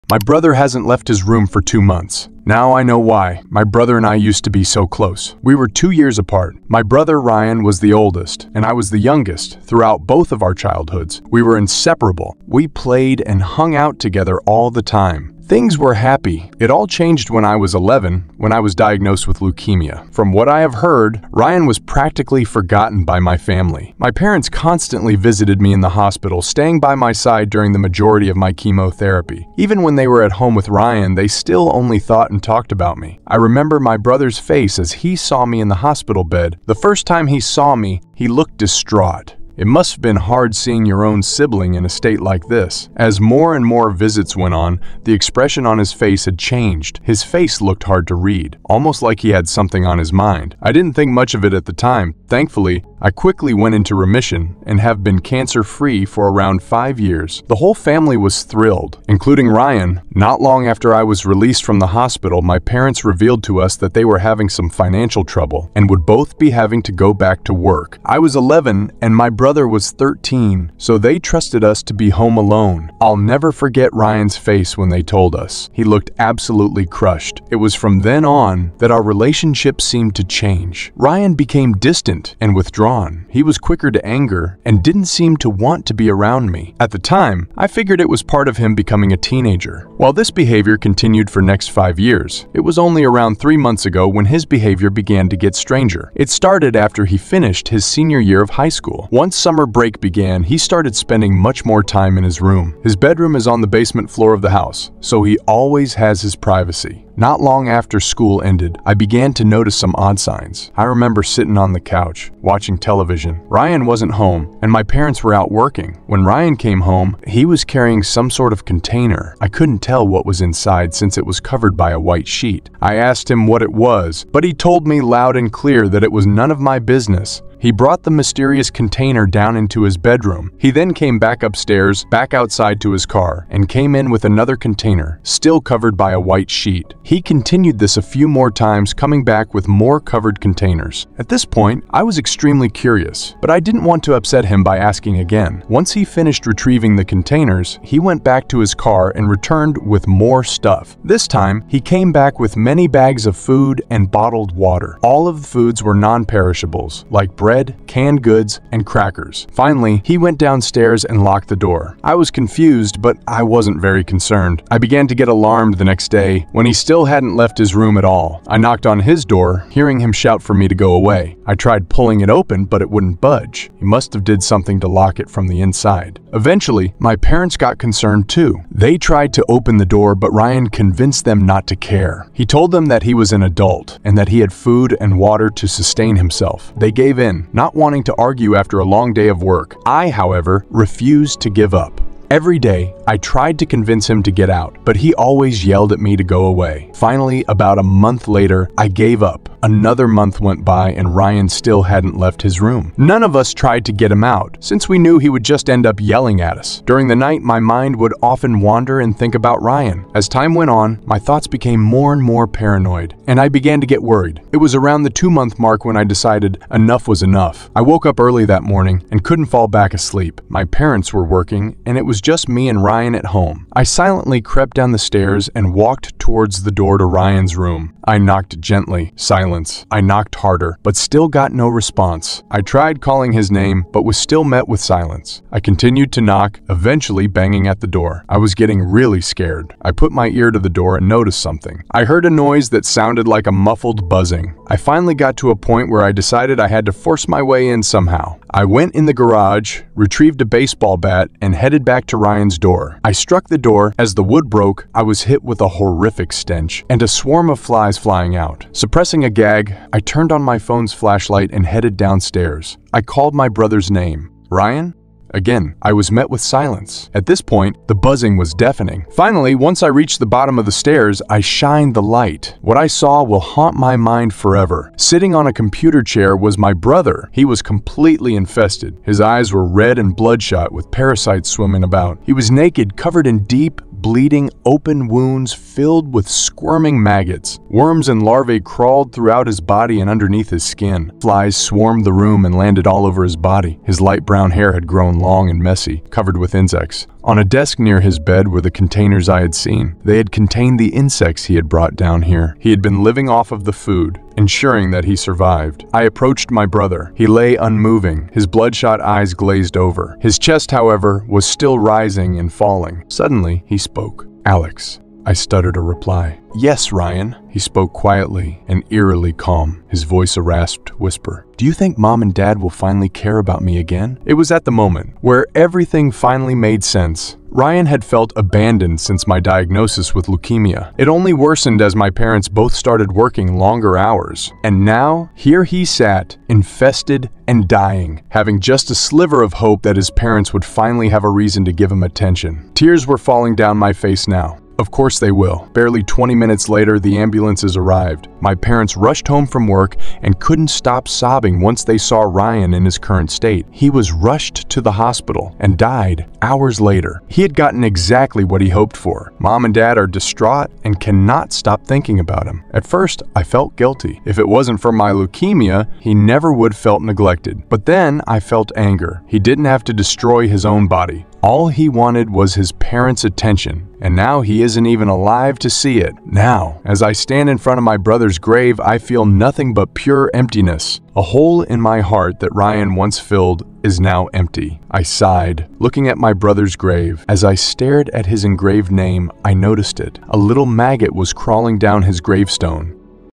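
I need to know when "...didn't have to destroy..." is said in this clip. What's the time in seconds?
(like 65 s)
369 s.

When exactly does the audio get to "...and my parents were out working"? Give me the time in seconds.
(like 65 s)
114 s.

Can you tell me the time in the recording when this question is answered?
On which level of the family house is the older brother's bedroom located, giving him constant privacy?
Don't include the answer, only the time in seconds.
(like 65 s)
103 s.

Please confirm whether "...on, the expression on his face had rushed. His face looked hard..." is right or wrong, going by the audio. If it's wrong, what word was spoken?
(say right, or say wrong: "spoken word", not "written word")
wrong: "changed", not "rushed".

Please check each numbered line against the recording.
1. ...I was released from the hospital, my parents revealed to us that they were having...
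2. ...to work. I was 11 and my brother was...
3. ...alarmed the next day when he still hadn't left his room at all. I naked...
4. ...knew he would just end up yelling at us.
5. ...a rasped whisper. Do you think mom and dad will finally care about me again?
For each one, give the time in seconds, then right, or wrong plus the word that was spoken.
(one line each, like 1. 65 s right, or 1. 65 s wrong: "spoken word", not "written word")
1. 60 s right
2. 67 s right
3. 165 s wrong: "knocked", not "naked"
4. 204 s right
5. 320 s right.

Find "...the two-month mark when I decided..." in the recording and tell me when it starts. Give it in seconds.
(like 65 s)
215 s.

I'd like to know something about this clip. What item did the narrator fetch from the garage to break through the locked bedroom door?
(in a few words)
Baseball bat.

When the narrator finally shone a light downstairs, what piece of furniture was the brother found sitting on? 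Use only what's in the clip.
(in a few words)
Computer chair.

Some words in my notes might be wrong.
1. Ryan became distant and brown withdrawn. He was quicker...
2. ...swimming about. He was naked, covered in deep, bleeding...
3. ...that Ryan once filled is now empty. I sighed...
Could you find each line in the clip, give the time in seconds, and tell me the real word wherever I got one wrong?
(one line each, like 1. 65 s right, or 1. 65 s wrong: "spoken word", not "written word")
1. 80 s wrong: "withdrawn", not "brown"
2. 281 s right
3. 382 s right.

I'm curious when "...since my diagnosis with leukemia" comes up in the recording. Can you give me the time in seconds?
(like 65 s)
329 s.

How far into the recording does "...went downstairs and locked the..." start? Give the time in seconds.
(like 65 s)
160 s.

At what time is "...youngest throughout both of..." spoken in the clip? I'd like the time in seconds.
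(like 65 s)
8 s.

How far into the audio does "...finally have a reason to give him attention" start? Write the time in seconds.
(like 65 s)
340 s.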